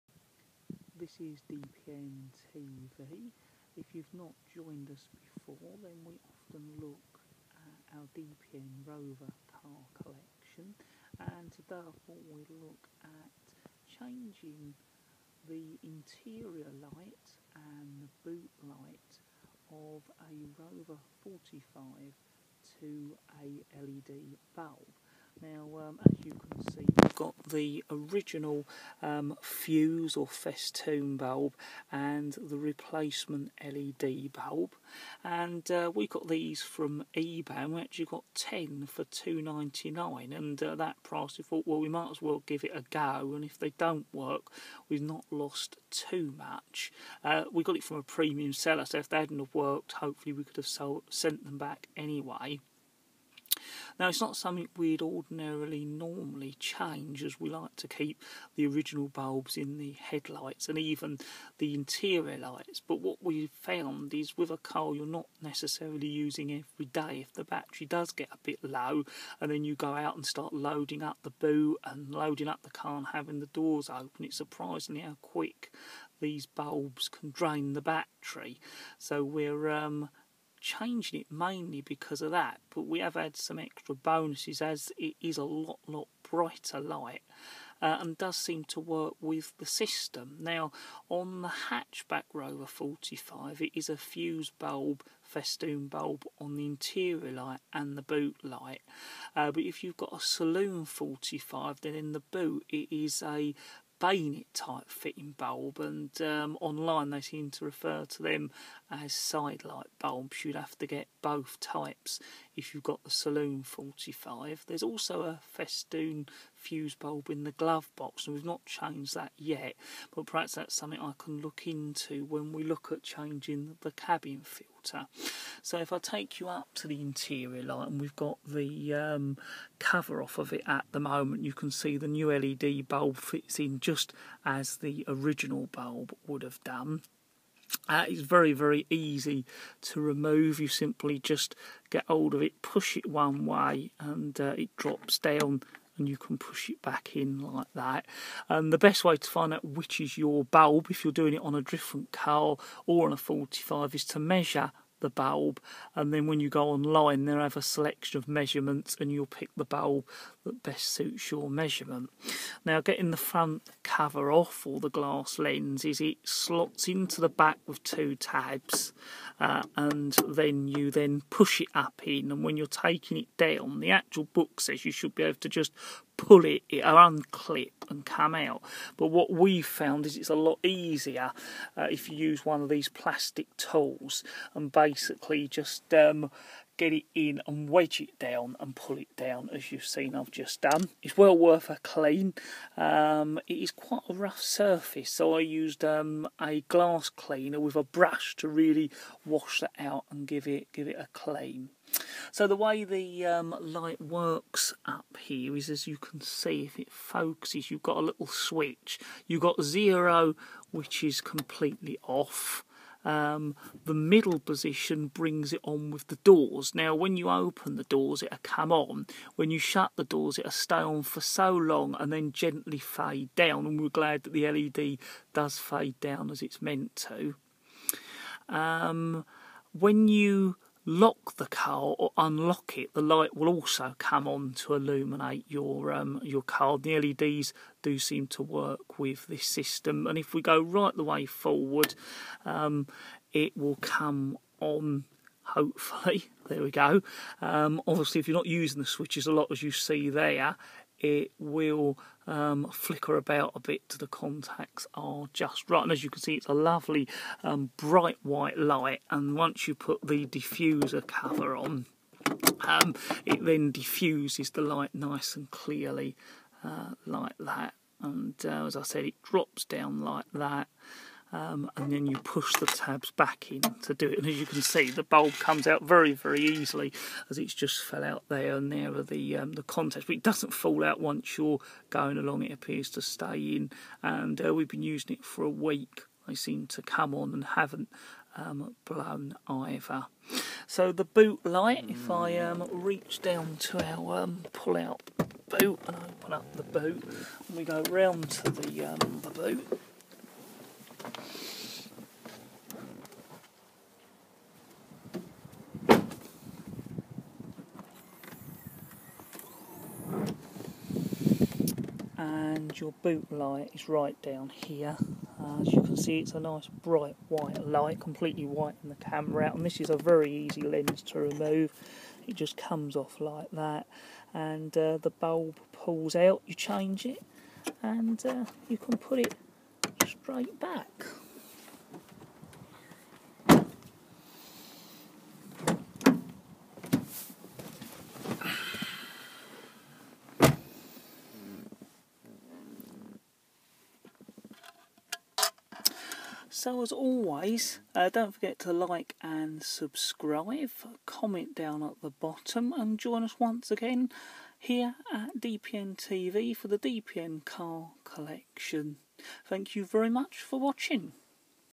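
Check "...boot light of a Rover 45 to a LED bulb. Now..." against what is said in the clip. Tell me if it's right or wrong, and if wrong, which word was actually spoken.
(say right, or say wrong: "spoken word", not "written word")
right.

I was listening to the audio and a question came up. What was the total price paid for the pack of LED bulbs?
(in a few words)
2.99.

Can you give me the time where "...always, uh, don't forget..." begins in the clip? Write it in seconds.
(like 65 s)
346 s.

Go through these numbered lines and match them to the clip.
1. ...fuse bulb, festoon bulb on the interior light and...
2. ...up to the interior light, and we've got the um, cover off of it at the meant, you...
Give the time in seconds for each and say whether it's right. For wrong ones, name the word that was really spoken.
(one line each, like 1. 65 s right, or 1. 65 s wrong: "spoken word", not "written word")
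1. 93 s right
2. 126 s wrong: "moment", not "meant".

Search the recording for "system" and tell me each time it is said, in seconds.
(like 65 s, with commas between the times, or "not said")
89 s, 239 s.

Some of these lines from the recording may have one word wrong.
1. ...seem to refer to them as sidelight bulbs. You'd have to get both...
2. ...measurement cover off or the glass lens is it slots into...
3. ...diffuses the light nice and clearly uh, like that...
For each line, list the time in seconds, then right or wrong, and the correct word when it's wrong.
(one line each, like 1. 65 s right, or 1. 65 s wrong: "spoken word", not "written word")
1. 107 s right
2. 163 s wrong: "front", not "measurement"
3. 263 s right.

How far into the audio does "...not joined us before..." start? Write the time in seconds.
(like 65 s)
4 s.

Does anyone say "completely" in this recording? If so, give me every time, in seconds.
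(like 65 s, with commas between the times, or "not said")
211 s, 317 s.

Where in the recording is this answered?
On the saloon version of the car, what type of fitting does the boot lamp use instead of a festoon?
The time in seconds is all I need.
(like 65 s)
104 s.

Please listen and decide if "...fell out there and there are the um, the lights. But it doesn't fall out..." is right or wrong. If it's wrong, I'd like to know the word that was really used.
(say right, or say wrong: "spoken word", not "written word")
wrong: "contacts", not "lights".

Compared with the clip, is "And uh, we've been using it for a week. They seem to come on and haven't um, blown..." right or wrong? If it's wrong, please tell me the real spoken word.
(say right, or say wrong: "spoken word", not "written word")
right.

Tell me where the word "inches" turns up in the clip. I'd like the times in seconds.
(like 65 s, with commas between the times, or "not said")
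not said.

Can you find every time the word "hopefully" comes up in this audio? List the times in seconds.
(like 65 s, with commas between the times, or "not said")
49 s, 245 s.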